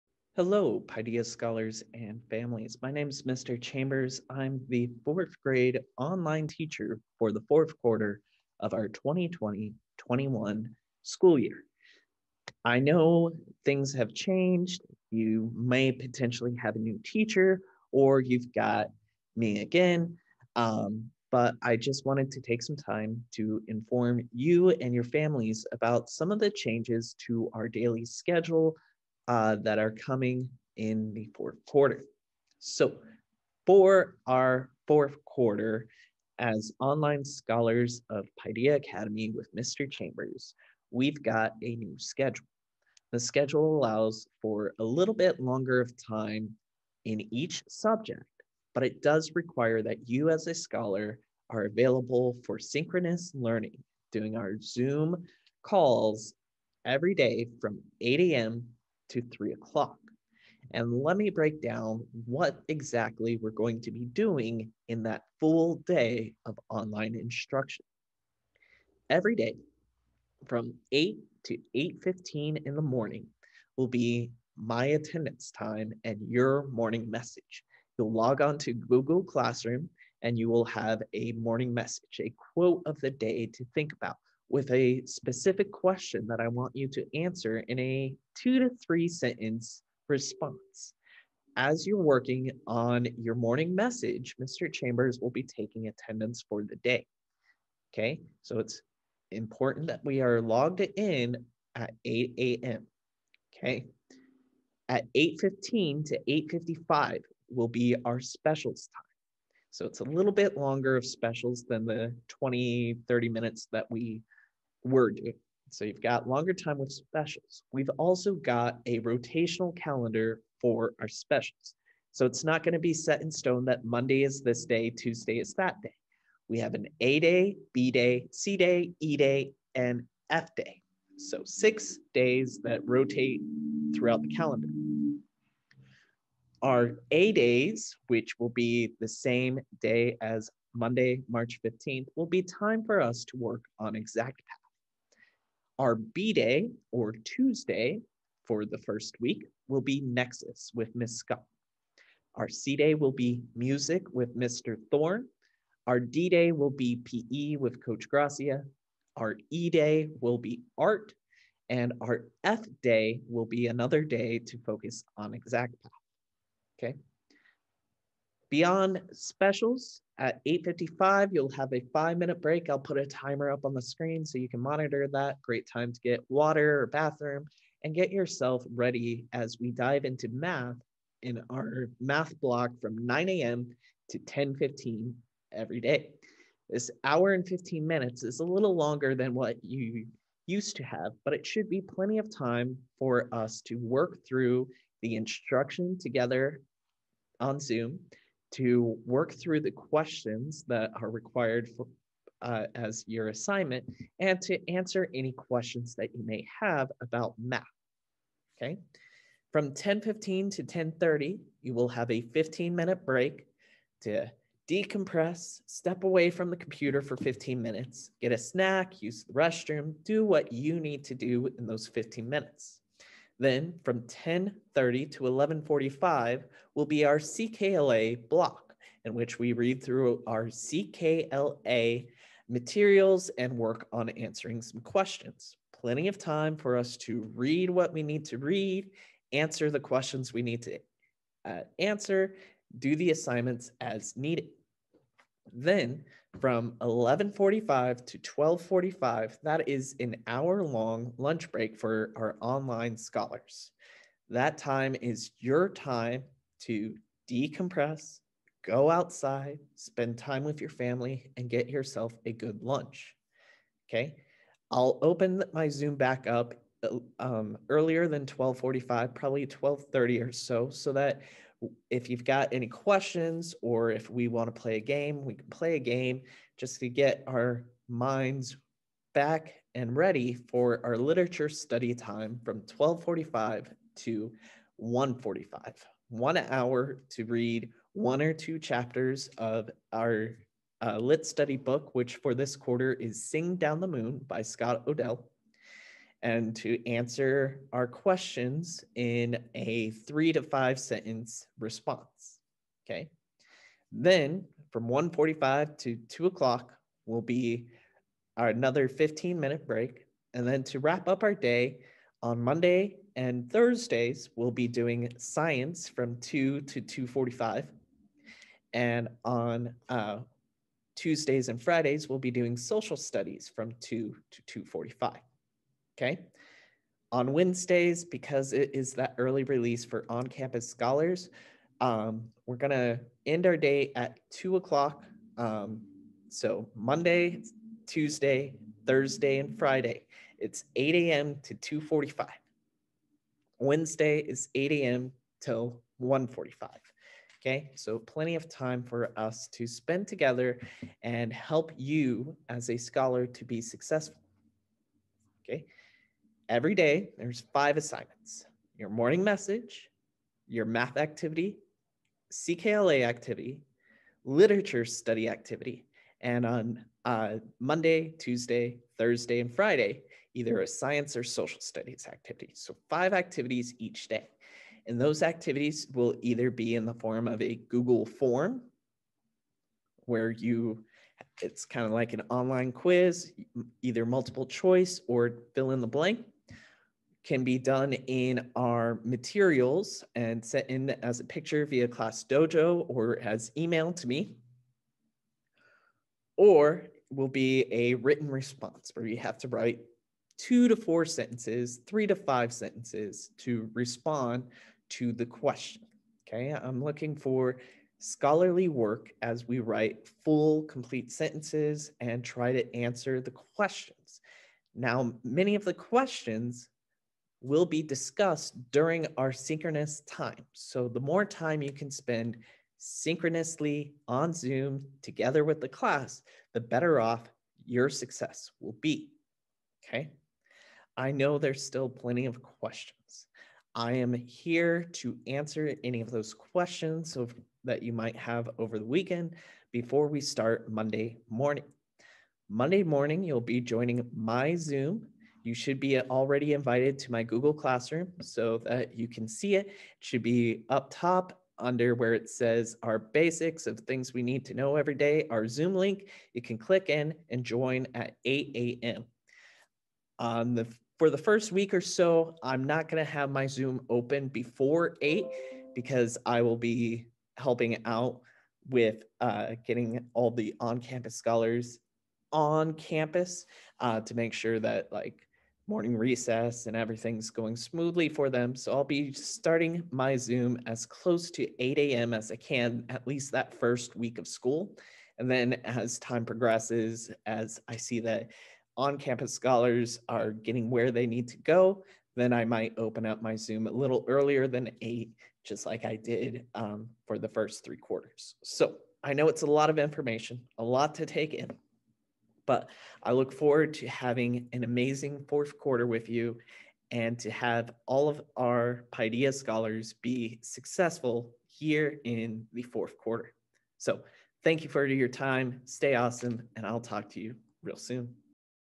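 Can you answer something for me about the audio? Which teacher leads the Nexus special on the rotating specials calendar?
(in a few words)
Miss Scott.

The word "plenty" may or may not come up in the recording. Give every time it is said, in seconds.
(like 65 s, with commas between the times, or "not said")
191 s, 235 s, 347 s, 431 s.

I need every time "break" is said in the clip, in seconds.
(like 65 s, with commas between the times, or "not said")
61 s, 172 s, 213 s, 251 s, 309 s.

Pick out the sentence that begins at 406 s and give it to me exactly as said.
Okay, I'm looking for scholarly work as we write full, complete sentences and try to answer the questions.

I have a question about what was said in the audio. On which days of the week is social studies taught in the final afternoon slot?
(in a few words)
Tuesdays and Fridays.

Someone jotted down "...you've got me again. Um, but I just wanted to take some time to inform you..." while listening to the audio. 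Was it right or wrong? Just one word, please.
right.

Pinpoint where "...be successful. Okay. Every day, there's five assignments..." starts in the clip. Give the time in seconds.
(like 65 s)
353 s.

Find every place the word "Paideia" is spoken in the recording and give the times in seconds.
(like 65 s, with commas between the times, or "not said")
0 s, 38 s, 508 s.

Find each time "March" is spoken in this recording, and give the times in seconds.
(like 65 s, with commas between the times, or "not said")
141 s.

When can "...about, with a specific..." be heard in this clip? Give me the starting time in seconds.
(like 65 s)
83 s.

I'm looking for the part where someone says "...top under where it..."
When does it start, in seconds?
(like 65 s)
450 s.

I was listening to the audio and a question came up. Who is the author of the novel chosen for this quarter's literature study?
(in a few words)
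Scott O'Dell.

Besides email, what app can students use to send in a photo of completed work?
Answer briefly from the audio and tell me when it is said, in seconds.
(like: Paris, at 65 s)
Class Dojo, at 391 s.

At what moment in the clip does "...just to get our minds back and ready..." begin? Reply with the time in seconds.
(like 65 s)
276 s.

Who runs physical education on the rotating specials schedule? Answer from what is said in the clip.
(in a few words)
Coach Gracia.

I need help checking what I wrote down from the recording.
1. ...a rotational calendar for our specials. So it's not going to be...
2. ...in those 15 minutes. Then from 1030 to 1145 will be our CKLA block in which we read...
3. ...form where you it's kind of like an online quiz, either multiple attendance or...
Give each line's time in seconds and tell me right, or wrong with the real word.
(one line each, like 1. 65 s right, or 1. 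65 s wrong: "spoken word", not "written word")
1. 118 s right
2. 221 s right
3. 378 s wrong: "choice", not "attendance".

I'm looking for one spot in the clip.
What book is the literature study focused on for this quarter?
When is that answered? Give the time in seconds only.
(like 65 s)
293 s.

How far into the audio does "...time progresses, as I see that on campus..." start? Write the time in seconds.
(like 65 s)
485 s.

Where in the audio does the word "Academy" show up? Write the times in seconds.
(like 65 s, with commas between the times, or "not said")
38 s.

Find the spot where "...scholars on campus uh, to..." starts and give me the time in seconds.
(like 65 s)
471 s.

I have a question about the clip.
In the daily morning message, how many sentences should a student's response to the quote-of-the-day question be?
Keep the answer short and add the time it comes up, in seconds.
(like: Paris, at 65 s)
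2 to 3, at 88 s.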